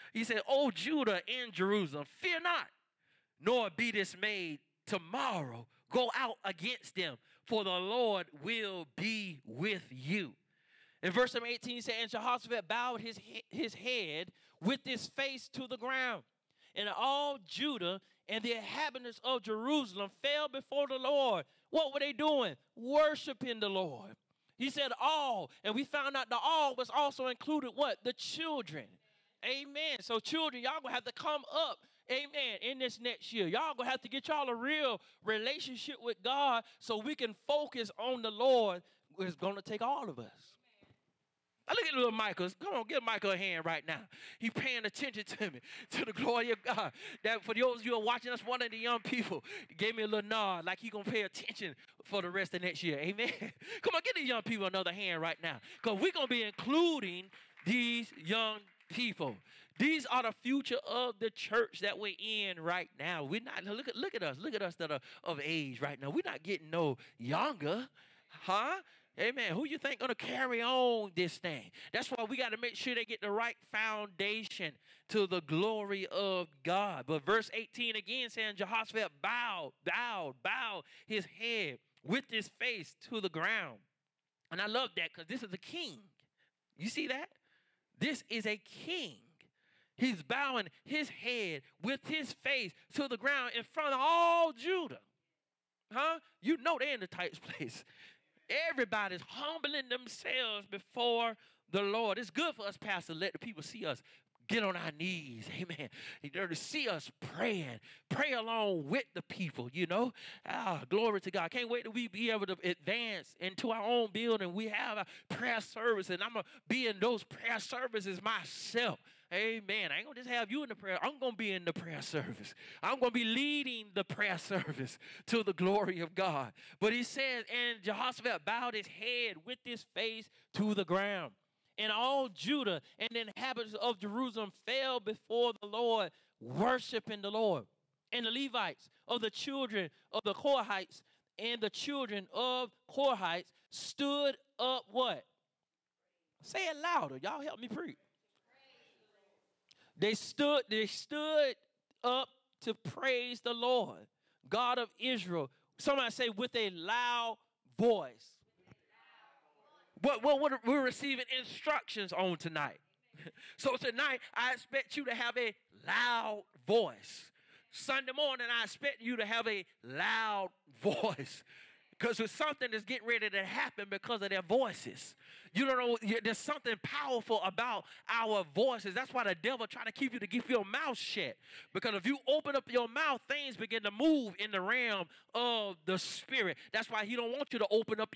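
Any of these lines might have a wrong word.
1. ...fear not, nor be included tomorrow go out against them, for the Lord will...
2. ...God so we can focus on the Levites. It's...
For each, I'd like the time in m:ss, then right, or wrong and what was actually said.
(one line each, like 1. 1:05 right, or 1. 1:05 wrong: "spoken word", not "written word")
1. 0:02 wrong: "dismayed", not "included"
2. 0:36 wrong: "Lord", not "Levites".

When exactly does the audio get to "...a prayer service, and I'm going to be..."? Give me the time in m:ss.
1:54.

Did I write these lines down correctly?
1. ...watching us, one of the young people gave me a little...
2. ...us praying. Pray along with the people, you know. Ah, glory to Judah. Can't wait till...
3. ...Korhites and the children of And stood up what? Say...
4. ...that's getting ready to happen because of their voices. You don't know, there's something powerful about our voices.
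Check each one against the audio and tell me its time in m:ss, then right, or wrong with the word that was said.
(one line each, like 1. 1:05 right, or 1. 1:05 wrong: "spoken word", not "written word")
1. 0:48 right
2. 1:46 wrong: "God", not "Judah"
3. 2:20 wrong: "Korhites", not "And"
4. 2:52 right.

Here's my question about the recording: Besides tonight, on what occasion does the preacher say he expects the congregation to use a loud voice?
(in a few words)
Sunday morning.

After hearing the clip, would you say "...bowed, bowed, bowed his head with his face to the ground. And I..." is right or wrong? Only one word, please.
right.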